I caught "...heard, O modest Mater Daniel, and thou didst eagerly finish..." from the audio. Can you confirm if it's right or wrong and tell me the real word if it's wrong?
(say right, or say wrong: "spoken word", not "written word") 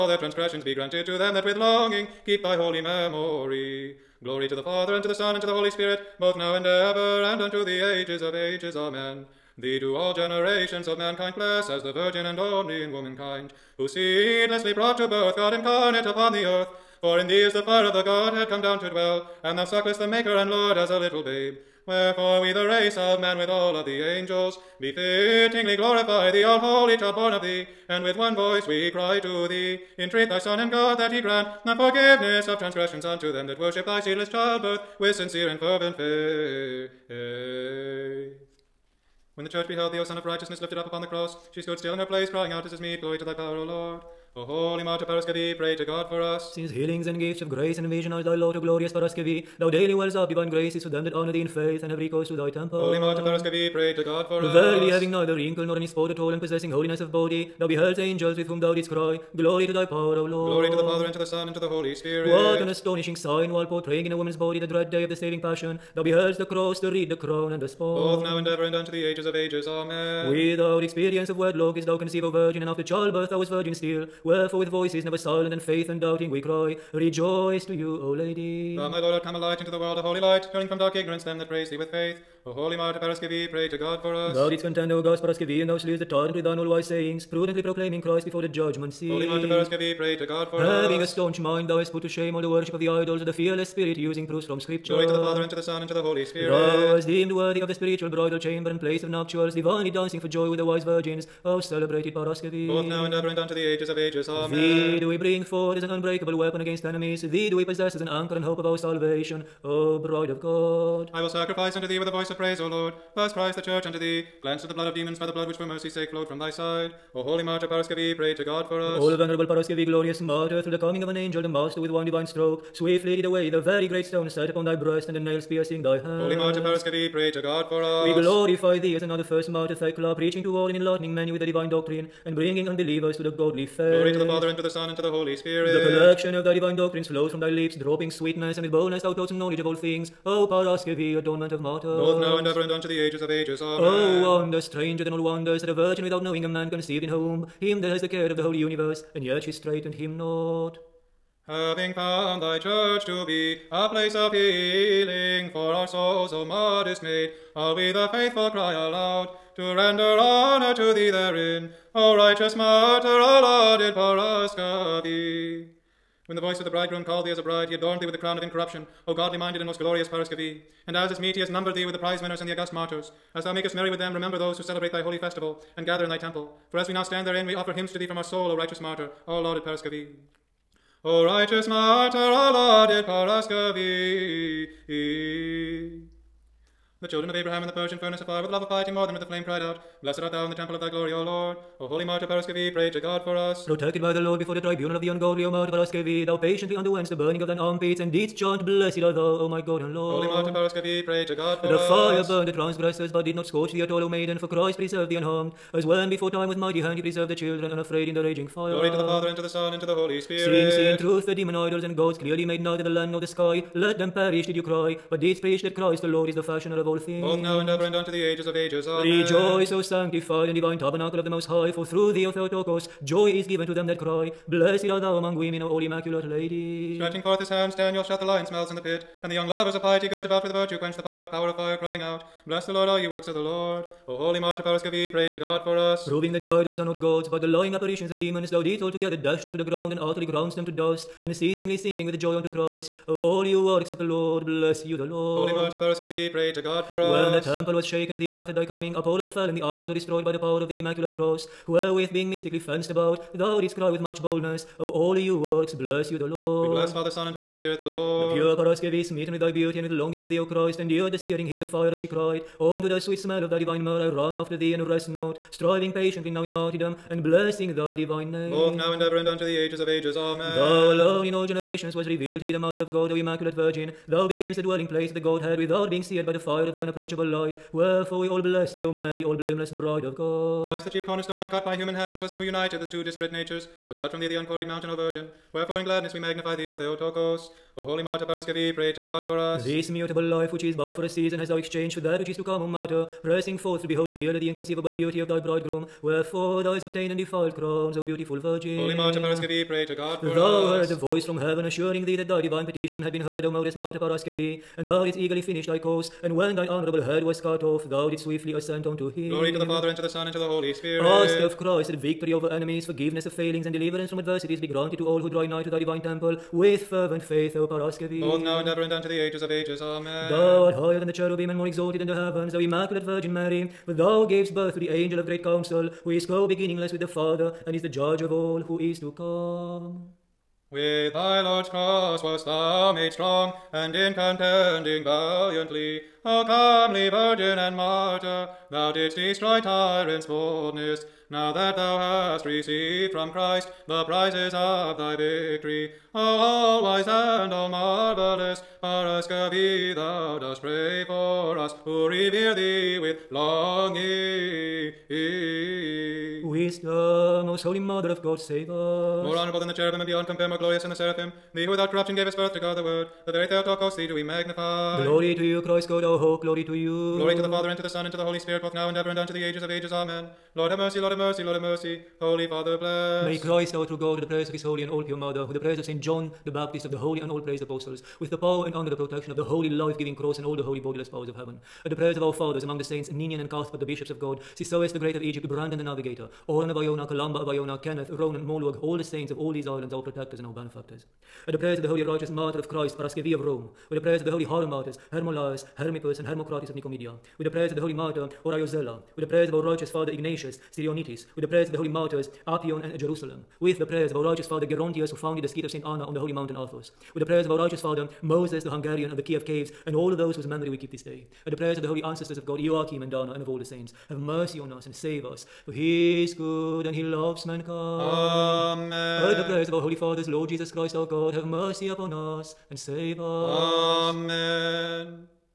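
wrong: "Paraskevi", not "Daniel".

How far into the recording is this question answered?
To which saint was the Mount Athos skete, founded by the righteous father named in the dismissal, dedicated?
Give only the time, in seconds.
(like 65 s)
405 s.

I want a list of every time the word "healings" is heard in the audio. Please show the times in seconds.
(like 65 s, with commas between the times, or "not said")
46 s, 154 s.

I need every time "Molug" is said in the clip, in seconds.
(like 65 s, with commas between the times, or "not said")
388 s.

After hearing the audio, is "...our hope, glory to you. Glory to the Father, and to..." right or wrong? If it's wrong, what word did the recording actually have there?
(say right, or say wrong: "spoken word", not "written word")
right.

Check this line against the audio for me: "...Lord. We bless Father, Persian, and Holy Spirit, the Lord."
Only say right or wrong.
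wrong.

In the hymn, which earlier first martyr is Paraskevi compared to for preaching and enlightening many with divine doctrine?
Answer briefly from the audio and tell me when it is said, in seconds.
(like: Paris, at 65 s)
Thecla, at 129 s.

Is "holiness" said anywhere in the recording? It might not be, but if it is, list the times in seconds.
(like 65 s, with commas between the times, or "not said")
56 s.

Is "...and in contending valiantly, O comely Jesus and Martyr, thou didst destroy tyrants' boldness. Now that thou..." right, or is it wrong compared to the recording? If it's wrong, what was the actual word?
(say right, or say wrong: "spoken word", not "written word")
wrong: "Virgin", not "Jesus".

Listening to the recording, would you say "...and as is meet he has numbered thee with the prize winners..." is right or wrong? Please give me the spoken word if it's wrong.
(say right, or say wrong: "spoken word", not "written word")
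right.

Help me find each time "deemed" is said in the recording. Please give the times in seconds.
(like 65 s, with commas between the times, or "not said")
97 s.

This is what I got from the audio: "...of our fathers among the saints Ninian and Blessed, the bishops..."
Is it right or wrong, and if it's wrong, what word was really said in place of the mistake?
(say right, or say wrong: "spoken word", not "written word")
wrong: "Cuthbert", not "Blessed".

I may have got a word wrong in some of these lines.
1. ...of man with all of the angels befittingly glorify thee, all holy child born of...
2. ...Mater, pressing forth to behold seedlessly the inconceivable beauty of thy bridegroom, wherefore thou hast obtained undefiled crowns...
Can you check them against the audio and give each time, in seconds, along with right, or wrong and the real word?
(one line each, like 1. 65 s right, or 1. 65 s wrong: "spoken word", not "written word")
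1. 22 s right
2. 292 s wrong: "clearly", not "seedlessly".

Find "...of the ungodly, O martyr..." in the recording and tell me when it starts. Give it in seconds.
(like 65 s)
194 s.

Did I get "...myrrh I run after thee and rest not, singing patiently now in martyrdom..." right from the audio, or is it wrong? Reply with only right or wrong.
wrong.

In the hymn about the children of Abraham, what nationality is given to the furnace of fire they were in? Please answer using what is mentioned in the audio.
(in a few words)
Persian.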